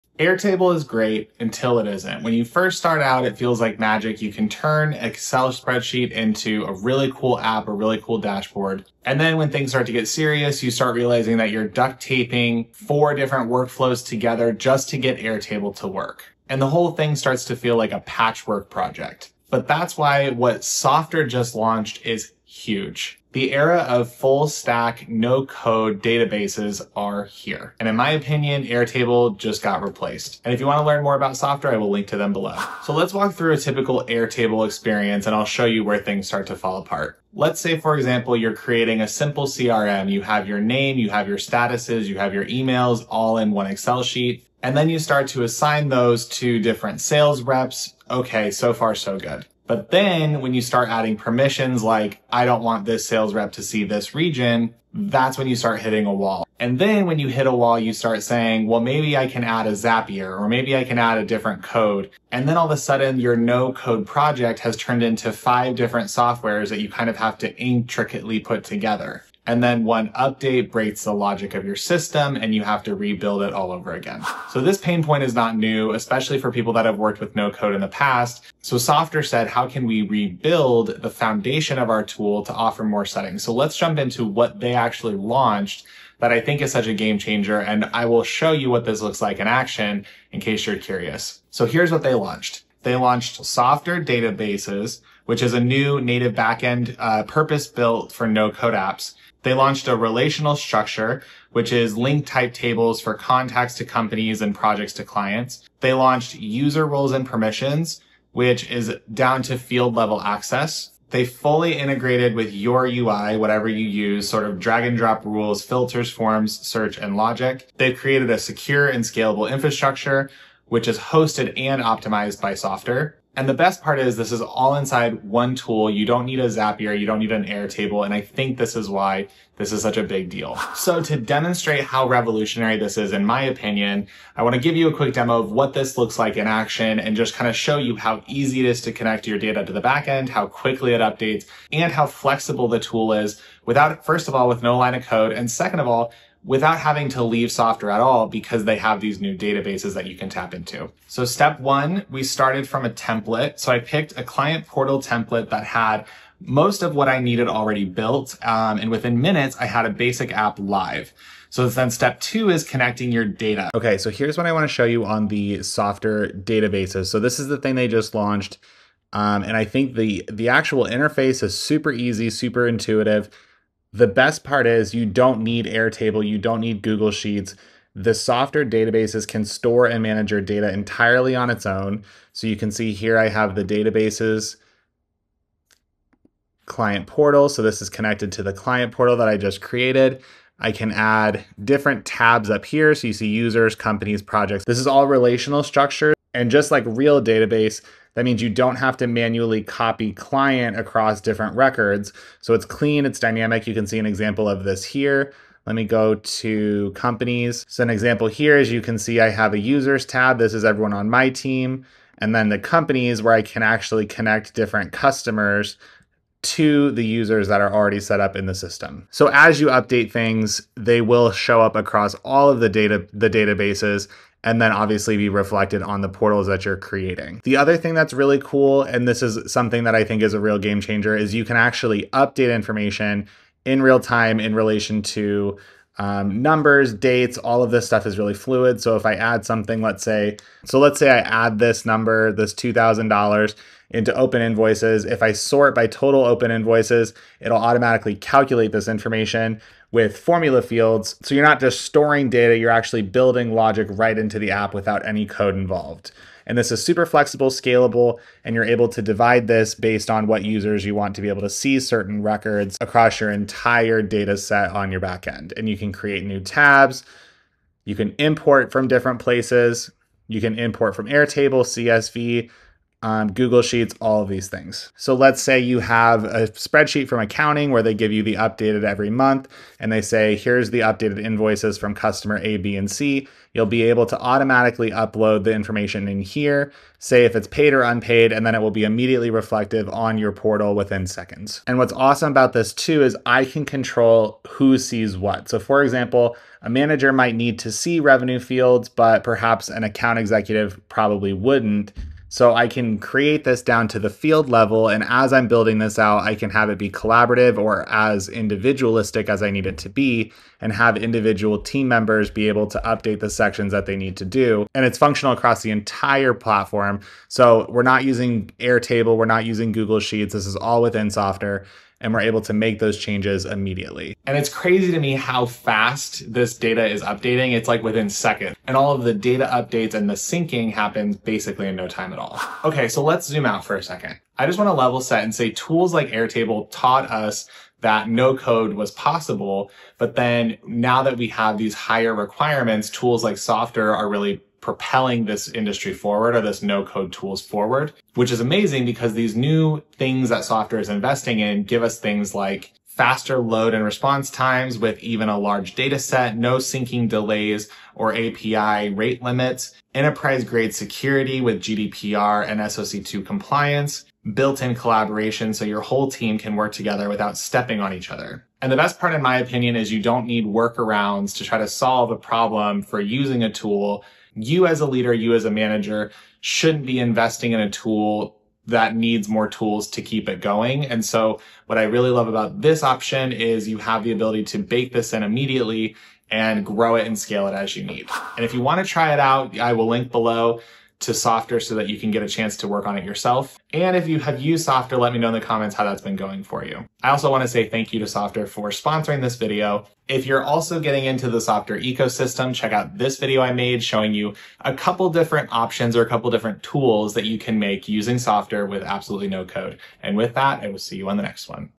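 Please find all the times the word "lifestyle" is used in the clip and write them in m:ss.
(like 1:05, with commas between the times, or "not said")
not said.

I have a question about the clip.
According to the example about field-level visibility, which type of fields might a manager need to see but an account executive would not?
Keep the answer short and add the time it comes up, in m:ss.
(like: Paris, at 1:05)
Revenue fields, at 4:57.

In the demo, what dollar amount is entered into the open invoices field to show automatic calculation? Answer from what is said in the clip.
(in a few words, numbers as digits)
$2,000.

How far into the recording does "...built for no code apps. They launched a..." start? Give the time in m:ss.
1:37.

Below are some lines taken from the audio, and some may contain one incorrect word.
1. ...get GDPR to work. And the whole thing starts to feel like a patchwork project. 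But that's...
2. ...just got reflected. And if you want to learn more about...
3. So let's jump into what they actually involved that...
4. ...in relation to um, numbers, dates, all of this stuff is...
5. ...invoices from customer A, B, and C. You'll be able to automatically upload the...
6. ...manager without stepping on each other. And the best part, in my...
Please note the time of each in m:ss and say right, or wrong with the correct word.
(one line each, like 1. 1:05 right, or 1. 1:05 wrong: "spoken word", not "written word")
1. 0:14 wrong: "Airtable", not "GDPR"
2. 0:29 wrong: "replaced", not "reflected"
3. 1:23 wrong: "launched", not "involved"
4. 3:54 right
5. 4:41 right
6. 6:06 wrong: "together", not "manager".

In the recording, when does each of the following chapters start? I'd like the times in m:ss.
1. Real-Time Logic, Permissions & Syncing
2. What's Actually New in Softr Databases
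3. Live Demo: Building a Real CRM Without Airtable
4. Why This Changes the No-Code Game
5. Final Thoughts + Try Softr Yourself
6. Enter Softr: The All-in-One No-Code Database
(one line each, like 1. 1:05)
1. 4:25
2. 1:30
3. 2:15
4. 5:32
5. 6:35
6. 0:20.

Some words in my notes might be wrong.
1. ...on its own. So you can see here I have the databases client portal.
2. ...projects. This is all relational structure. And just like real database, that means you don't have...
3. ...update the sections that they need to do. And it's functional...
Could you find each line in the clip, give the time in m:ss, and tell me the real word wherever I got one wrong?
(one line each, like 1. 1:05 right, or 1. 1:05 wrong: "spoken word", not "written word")
1. 3:01 right
2. 3:14 right
3. 5:12 right.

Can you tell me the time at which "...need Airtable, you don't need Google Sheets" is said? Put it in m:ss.
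2:55.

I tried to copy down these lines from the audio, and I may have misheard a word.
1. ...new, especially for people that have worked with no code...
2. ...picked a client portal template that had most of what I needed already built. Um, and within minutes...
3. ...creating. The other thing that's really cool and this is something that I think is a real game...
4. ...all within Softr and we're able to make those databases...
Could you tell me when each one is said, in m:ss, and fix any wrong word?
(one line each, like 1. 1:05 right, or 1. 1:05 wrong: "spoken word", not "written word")
1. 1:15 right
2. 2:33 right
3. 3:46 right
4. 5:20 wrong: "changes", not "databases".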